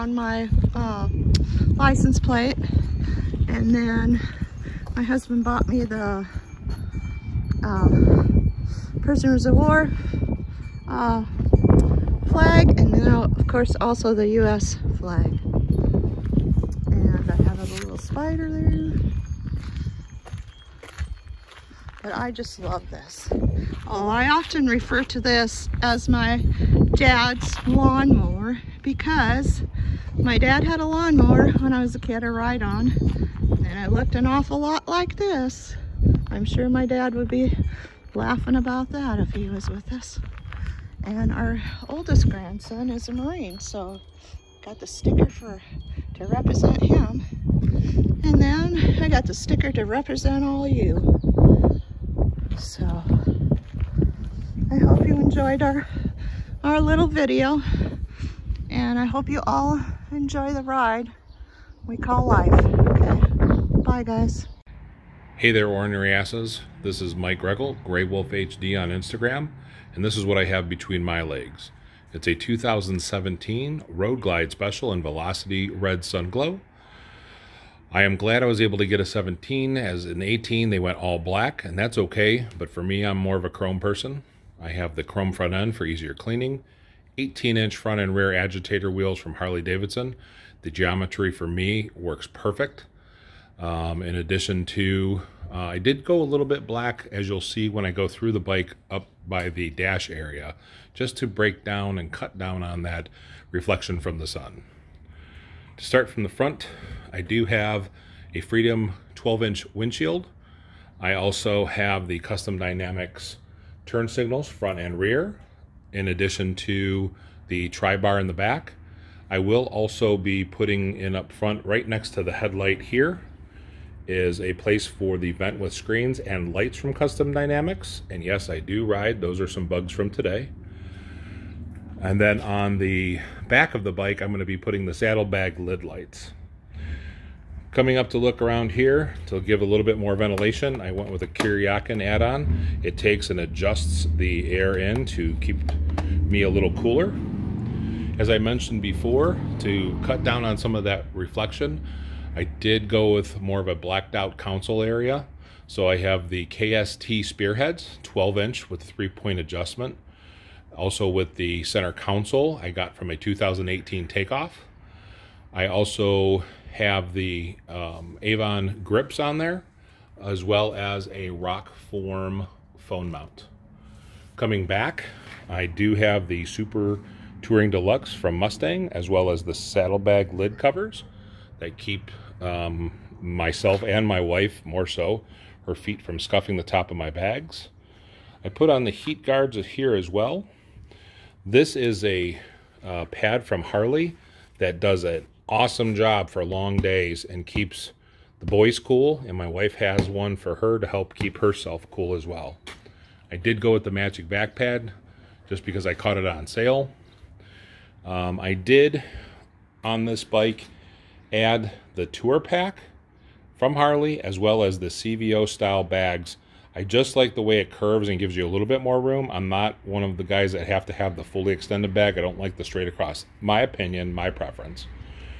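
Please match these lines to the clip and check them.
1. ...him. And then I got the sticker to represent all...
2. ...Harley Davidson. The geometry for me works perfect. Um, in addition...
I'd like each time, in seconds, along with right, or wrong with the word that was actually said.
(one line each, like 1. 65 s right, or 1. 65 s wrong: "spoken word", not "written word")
1. 46 s right
2. 89 s right.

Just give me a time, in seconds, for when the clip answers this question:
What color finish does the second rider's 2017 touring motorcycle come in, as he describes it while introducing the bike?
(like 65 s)
75 s.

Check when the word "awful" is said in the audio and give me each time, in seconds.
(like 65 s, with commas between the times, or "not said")
34 s.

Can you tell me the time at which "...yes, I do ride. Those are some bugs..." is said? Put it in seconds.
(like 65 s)
128 s.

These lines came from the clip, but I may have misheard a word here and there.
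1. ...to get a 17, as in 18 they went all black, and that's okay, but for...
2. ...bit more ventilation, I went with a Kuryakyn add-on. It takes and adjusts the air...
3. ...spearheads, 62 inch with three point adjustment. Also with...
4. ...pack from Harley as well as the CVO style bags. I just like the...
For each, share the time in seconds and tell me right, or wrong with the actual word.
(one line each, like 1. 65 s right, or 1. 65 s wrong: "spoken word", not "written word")
1. 78 s right
2. 139 s right
3. 157 s wrong: "12", not "62"
4. 212 s right.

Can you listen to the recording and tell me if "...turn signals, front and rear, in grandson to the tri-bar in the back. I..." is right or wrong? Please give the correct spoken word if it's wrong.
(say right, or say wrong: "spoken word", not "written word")
wrong: "addition", not "grandson".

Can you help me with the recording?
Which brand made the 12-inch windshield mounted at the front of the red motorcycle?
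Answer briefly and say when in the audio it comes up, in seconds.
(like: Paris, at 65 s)
Freedom, at 108 s.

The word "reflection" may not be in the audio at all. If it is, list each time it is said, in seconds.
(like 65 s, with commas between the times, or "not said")
103 s, 151 s.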